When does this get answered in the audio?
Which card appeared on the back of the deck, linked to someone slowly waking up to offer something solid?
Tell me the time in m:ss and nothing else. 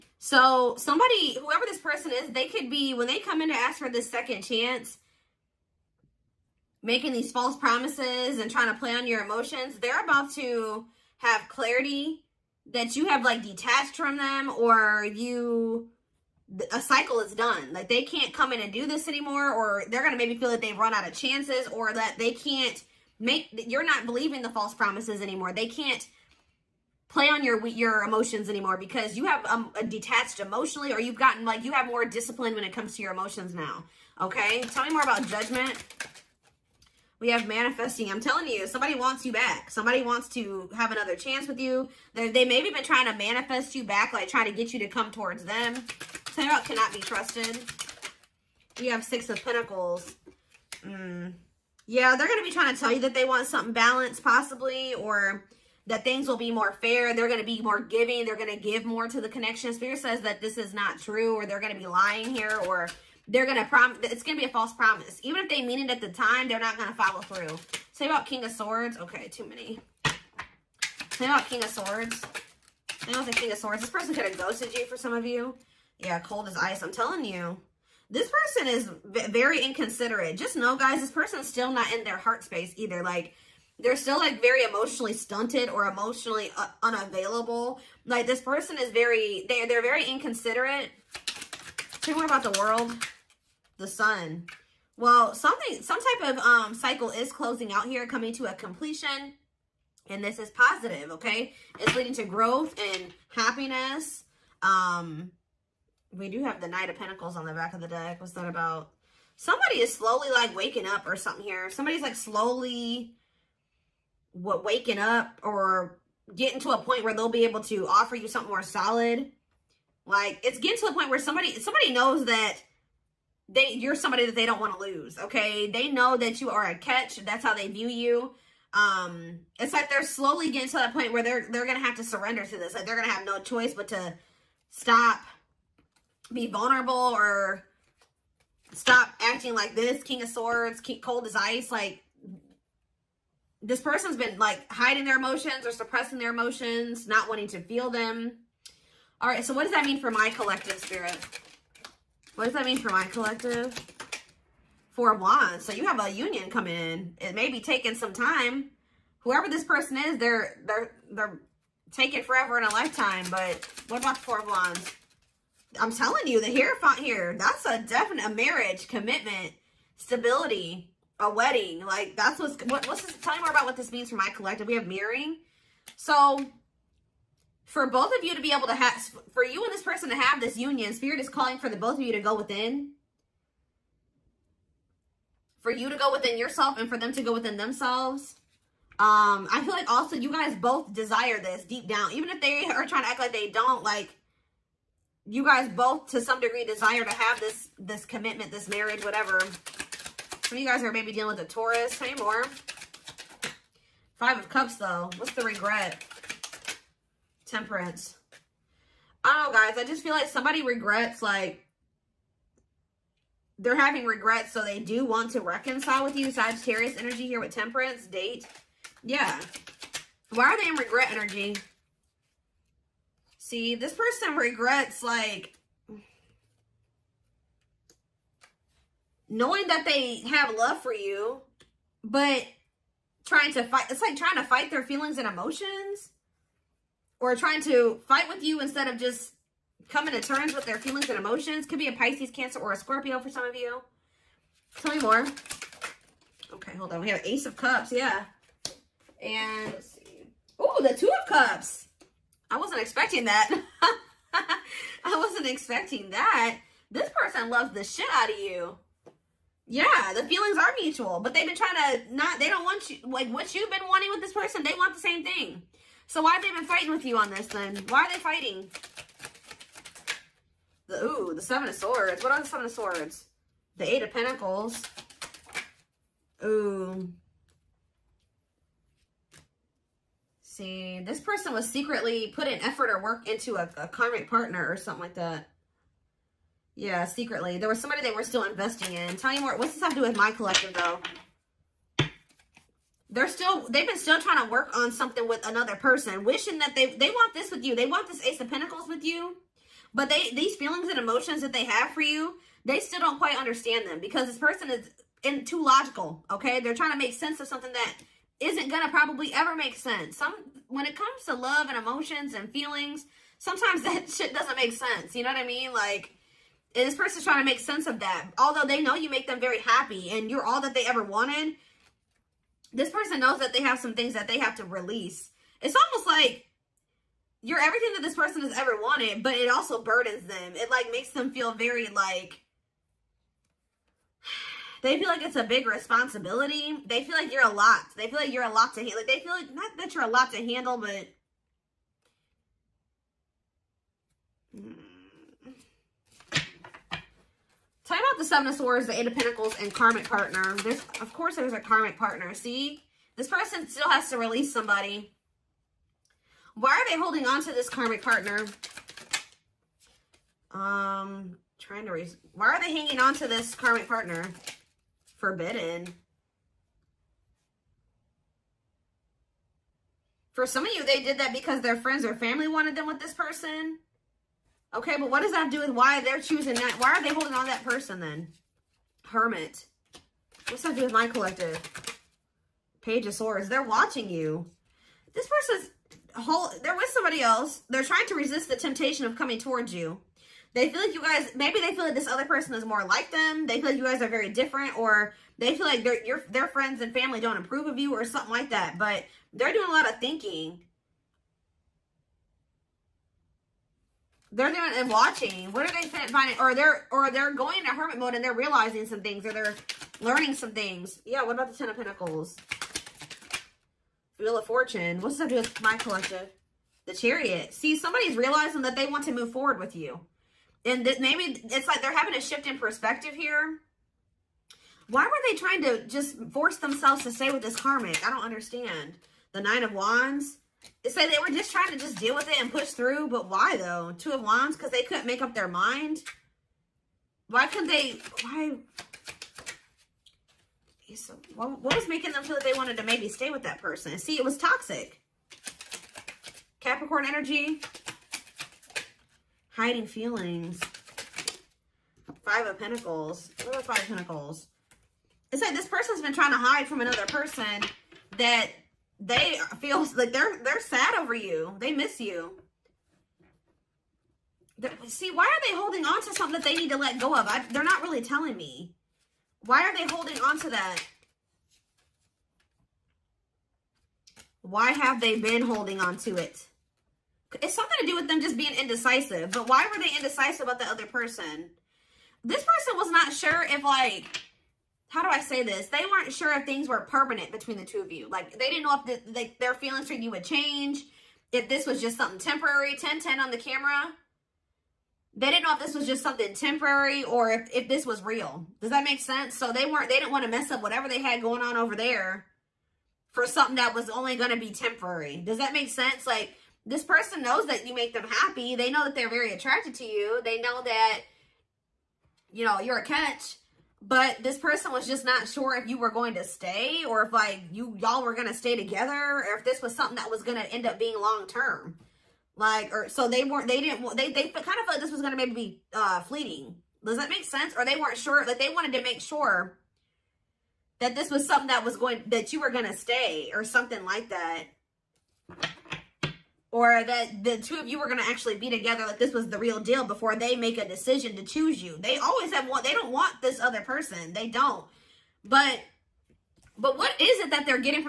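1:46.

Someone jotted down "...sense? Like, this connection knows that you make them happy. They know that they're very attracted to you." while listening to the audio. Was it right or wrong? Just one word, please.
wrong.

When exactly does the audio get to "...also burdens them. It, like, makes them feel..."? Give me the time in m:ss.
5:29.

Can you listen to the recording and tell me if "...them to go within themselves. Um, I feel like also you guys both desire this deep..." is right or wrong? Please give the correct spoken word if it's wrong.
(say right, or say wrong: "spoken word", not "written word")
right.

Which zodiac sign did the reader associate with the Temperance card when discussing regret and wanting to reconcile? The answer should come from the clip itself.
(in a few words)
Sagittarius.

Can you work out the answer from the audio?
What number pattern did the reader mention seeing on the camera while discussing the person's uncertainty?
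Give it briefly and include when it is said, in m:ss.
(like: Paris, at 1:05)
10-10, at 8:12.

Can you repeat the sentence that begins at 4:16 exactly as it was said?
This person loves the shit out of you.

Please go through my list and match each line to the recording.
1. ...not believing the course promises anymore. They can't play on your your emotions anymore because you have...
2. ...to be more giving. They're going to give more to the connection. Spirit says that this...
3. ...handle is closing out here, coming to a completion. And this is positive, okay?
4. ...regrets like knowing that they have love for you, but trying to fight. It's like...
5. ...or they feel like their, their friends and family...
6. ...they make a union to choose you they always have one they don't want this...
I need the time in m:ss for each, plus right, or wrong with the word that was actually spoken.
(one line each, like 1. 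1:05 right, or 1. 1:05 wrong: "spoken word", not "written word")
1. 0:23 wrong: "false", not "course"
2. 0:57 right
3. 1:36 wrong: "cycle", not "handle"
4. 3:44 right
5. 6:34 right
6. 9:00 wrong: "decision", not "union".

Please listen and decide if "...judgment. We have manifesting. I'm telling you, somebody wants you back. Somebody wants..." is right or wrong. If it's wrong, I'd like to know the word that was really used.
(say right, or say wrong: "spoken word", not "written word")
right.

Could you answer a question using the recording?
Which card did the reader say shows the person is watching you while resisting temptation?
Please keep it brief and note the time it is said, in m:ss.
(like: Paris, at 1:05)
Page of Swords, at 6:22.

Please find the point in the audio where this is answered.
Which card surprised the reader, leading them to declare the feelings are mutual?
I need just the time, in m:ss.
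4:10.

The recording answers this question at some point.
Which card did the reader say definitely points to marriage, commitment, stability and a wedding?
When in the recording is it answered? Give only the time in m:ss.
2:46.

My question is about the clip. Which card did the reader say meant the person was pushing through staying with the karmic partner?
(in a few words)
Nine of Wands.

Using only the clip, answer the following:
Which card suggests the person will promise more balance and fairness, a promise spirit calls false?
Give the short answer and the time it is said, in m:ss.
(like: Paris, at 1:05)
Six of Pentacles, at 0:49.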